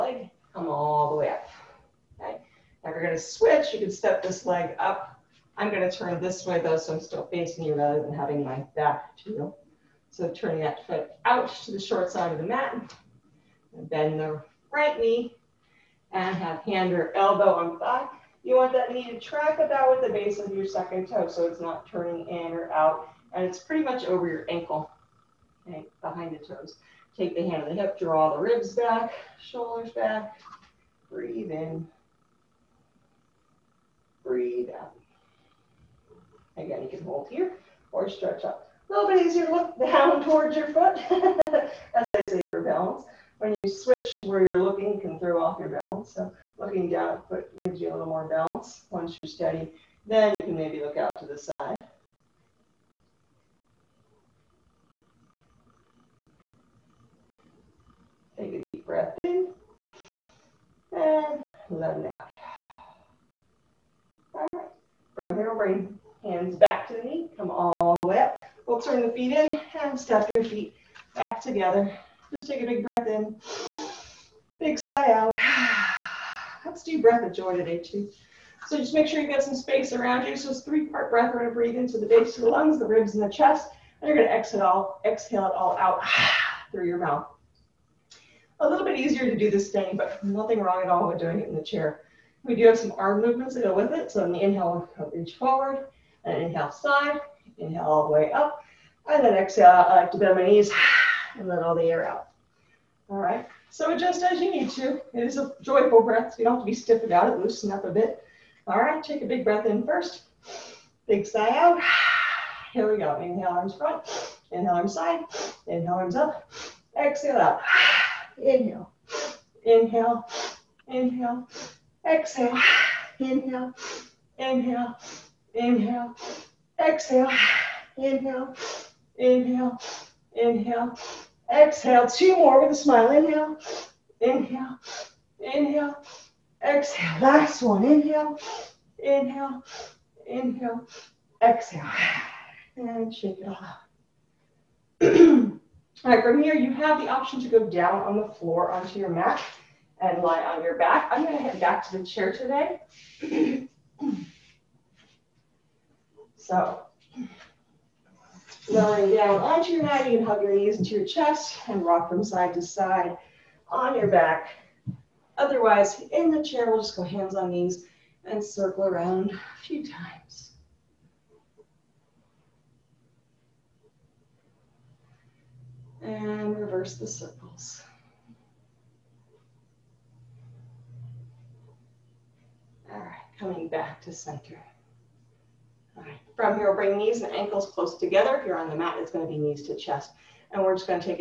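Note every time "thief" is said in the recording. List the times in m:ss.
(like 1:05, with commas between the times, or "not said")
not said.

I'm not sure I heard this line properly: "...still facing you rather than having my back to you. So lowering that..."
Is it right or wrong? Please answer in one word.
wrong.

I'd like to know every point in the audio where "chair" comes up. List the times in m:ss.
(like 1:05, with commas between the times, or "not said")
1:31, 2:32, 2:46.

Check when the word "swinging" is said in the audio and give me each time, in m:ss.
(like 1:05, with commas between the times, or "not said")
not said.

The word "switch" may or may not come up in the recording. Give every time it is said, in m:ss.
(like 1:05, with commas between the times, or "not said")
0:03, 0:43.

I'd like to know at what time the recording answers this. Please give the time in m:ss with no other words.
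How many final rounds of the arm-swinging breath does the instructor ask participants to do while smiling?
2:12.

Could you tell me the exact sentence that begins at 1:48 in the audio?
All right, take a big breath in first, big sigh out.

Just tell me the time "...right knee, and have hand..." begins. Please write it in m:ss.
0:14.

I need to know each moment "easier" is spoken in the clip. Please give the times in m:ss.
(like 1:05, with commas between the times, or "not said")
0:39, 1:28.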